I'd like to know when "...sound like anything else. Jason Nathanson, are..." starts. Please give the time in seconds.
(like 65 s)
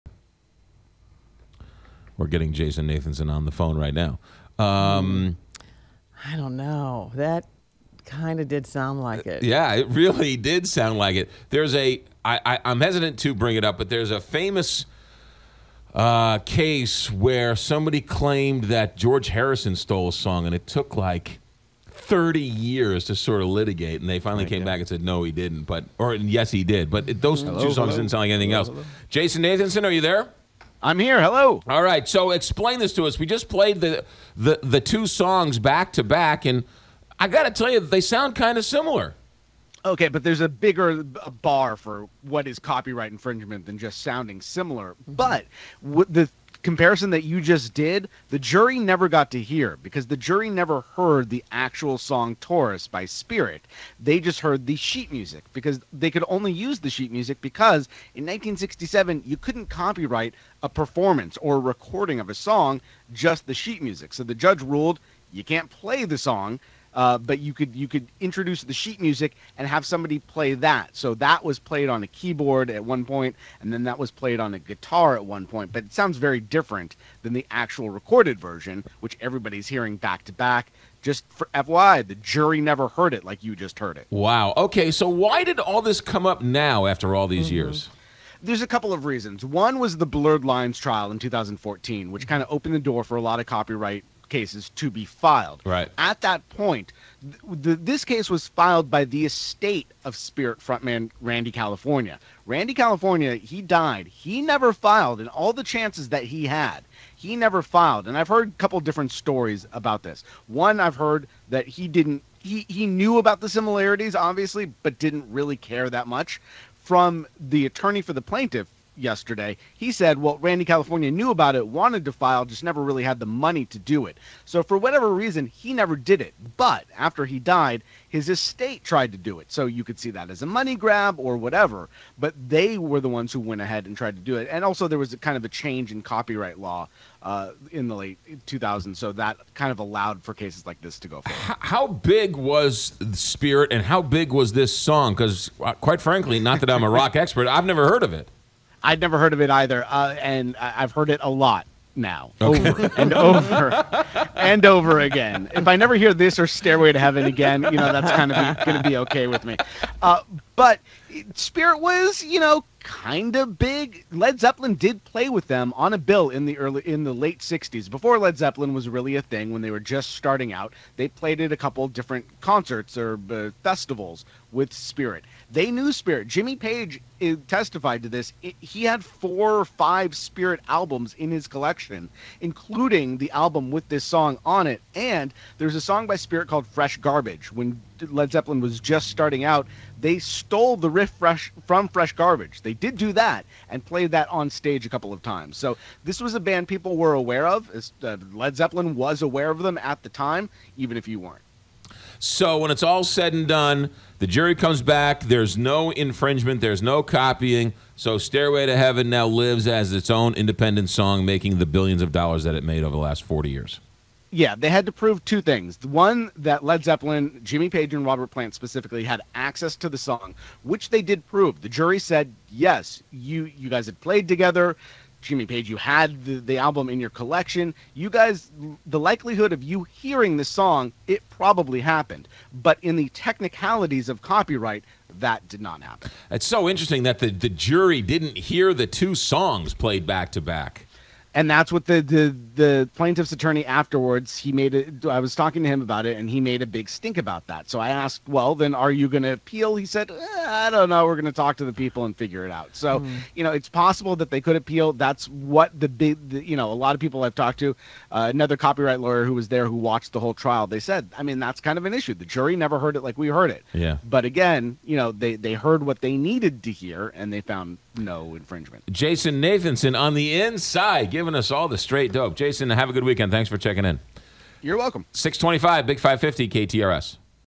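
28 s.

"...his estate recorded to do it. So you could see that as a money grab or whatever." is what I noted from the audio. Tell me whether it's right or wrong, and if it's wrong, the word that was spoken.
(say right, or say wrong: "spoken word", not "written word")
wrong: "tried", not "recorded".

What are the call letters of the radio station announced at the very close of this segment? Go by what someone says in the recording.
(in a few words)
KTRS.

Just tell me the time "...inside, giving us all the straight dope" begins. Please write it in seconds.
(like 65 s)
270 s.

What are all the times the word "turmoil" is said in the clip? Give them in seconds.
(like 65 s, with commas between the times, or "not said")
not said.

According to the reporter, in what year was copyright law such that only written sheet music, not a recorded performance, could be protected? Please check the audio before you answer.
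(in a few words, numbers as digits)
1967.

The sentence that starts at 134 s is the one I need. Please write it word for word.
And also, there was kind of a change in copyright law uh, in the late 2000s.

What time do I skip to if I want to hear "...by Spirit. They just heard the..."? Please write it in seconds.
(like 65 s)
52 s.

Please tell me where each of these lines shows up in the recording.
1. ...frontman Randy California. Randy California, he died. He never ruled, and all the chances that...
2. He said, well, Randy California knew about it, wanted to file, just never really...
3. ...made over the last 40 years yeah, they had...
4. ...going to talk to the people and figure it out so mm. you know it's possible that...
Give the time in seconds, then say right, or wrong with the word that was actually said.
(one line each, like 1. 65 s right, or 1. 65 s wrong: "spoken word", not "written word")
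1. 100 s wrong: "filed", not "ruled"
2. 119 s right
3. 212 s right
4. 251 s right.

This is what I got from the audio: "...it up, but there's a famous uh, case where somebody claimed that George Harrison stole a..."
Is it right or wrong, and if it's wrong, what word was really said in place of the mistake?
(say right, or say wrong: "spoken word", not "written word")
right.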